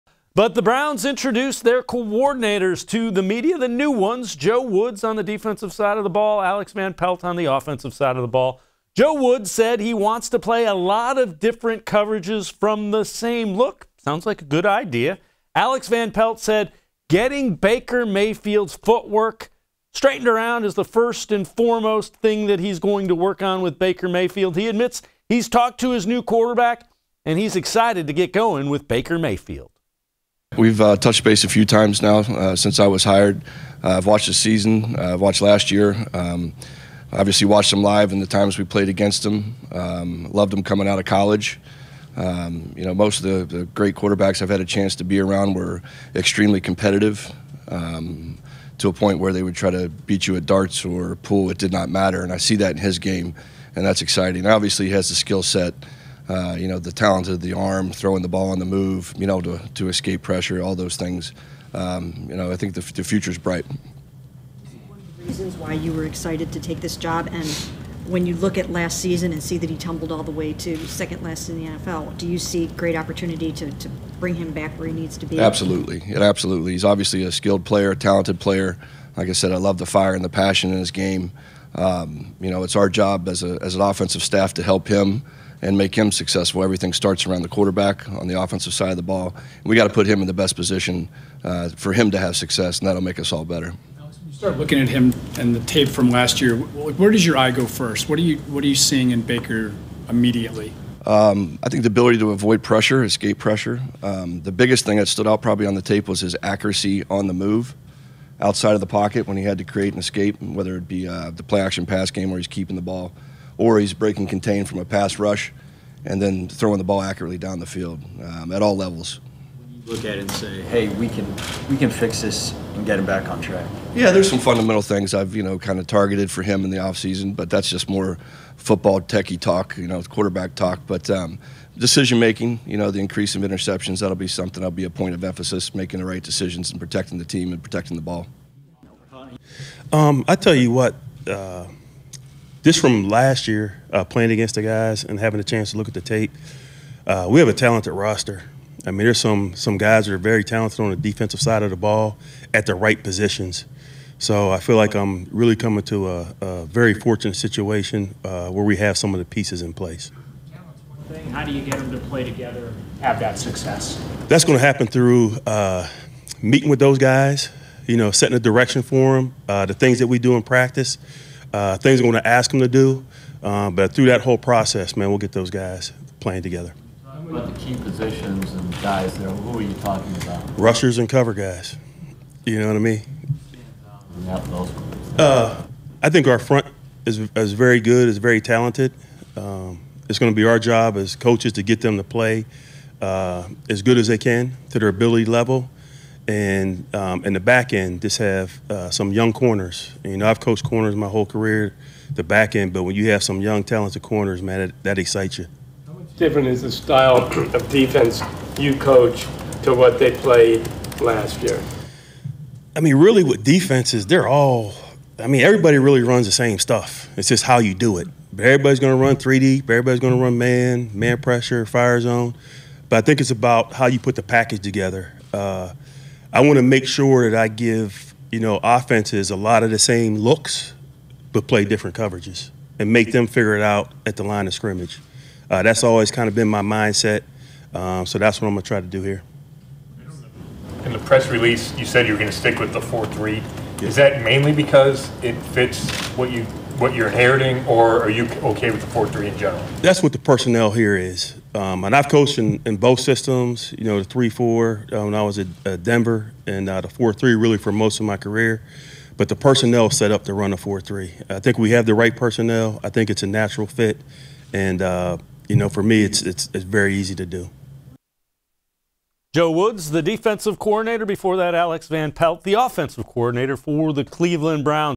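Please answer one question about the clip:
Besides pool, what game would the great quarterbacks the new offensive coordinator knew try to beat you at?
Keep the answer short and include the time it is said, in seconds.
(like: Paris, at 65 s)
darts, at 50 s.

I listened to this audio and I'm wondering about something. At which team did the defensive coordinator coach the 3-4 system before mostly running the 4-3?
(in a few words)
Denver.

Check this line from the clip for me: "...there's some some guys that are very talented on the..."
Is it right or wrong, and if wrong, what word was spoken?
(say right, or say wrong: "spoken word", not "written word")
right.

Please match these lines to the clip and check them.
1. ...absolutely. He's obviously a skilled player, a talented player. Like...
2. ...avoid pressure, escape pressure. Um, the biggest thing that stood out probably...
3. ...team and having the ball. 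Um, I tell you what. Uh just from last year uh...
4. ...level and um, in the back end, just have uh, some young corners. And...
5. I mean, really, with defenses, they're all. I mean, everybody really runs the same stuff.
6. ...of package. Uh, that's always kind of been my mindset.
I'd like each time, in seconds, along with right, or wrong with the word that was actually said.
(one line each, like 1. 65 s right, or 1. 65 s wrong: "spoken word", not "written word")
1. 76 s right
2. 102 s right
3. 137 s wrong: "protecting", not "having"
4. 195 s right
5. 212 s right
6. 234 s wrong: "scrimmage", not "package".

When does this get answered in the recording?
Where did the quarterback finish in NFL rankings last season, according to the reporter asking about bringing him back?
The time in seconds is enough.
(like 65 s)
70 s.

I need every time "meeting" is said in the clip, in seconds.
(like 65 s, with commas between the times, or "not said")
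166 s.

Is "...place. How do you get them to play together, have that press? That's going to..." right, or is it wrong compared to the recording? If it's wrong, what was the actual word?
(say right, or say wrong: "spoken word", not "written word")
wrong: "success", not "press".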